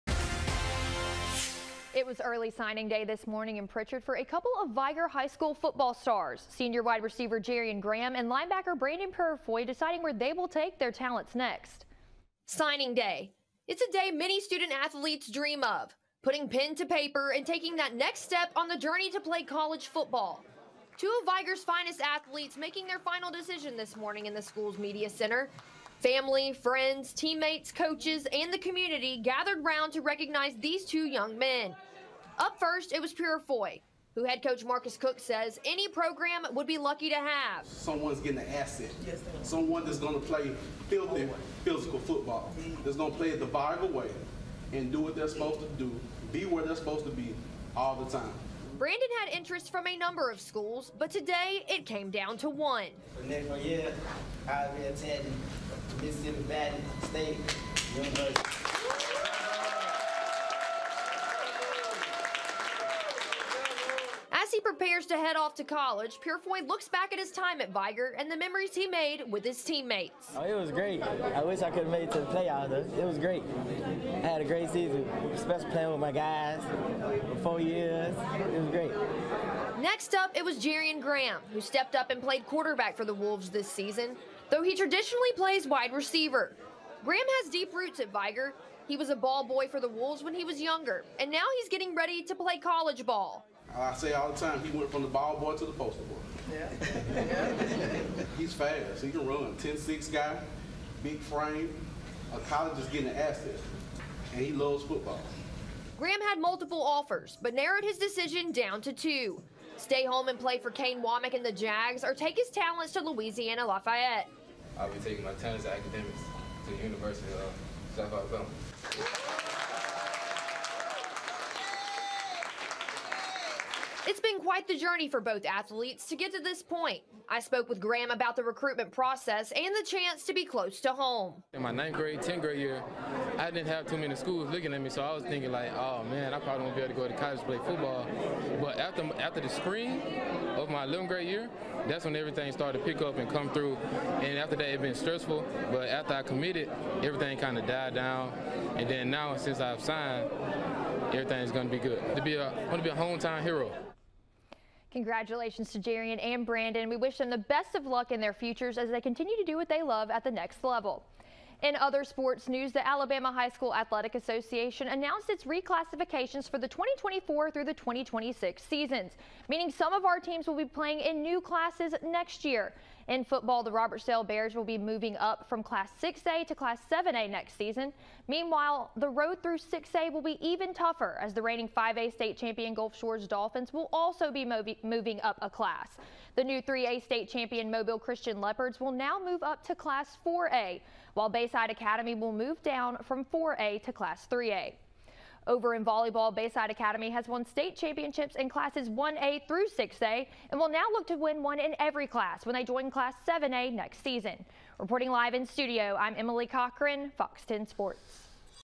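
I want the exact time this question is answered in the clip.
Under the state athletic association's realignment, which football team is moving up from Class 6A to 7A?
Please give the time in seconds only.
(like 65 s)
173 s.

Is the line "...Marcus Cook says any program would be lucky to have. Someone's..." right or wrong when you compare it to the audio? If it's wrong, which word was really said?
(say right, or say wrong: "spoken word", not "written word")
right.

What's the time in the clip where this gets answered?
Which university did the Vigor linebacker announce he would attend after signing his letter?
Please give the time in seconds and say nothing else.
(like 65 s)
56 s.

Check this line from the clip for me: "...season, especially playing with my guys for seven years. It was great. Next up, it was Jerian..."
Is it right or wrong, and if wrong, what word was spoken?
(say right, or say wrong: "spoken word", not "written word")
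wrong: "four", not "seven".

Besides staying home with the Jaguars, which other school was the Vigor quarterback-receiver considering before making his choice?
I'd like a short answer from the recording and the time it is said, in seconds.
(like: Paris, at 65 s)
Louisiana Lafayette, at 113 s.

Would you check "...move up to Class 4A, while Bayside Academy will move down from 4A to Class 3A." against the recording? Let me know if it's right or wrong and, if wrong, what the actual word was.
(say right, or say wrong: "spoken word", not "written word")
right.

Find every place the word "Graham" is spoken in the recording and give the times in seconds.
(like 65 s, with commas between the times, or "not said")
7 s, 81 s, 87 s, 105 s, 127 s.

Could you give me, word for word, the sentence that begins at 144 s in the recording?
And after that, it's been stressful.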